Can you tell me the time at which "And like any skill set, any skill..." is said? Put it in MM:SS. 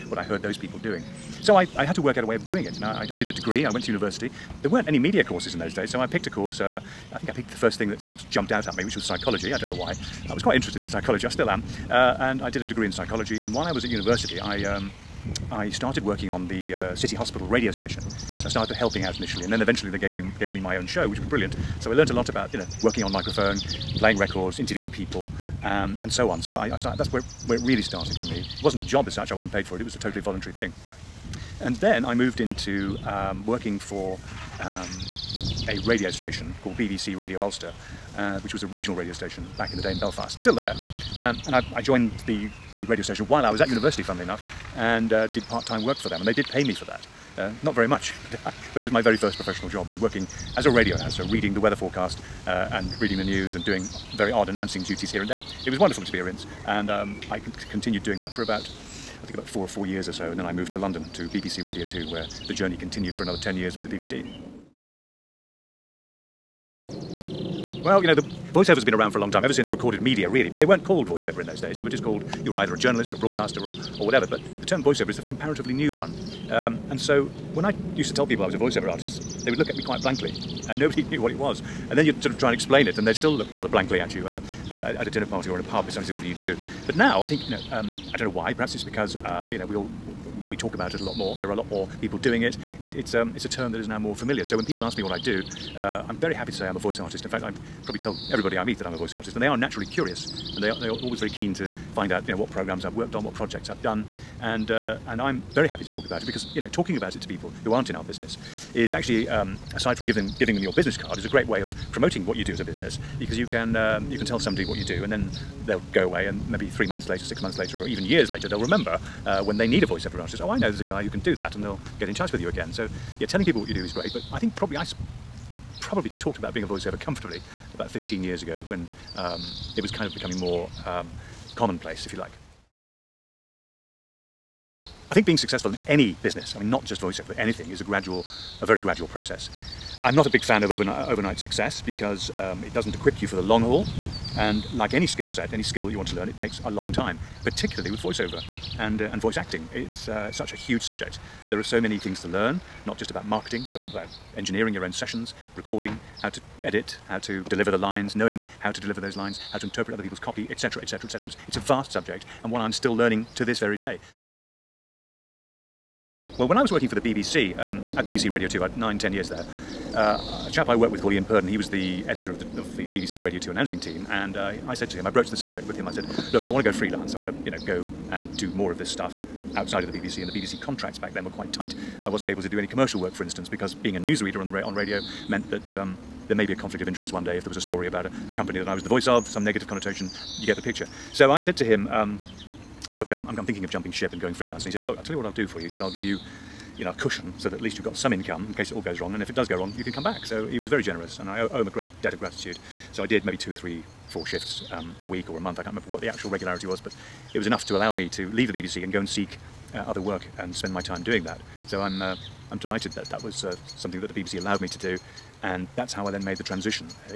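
02:24.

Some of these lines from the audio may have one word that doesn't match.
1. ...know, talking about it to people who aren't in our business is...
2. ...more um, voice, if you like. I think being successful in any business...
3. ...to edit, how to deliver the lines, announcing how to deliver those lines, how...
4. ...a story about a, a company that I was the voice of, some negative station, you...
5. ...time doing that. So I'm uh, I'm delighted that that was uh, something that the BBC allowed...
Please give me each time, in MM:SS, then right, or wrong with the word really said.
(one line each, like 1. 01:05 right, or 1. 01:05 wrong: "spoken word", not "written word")
1. 01:46 right
2. 02:10 wrong: "commonplace", not "voice"
3. 02:36 wrong: "knowing", not "announcing"
4. 03:07 wrong: "connotation", not "station"
5. 03:30 right.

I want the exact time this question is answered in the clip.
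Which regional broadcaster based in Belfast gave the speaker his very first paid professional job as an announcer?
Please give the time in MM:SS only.
00:36.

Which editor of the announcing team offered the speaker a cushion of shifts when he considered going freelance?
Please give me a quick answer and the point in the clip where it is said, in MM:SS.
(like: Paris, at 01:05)
Ian Purden, at 02:51.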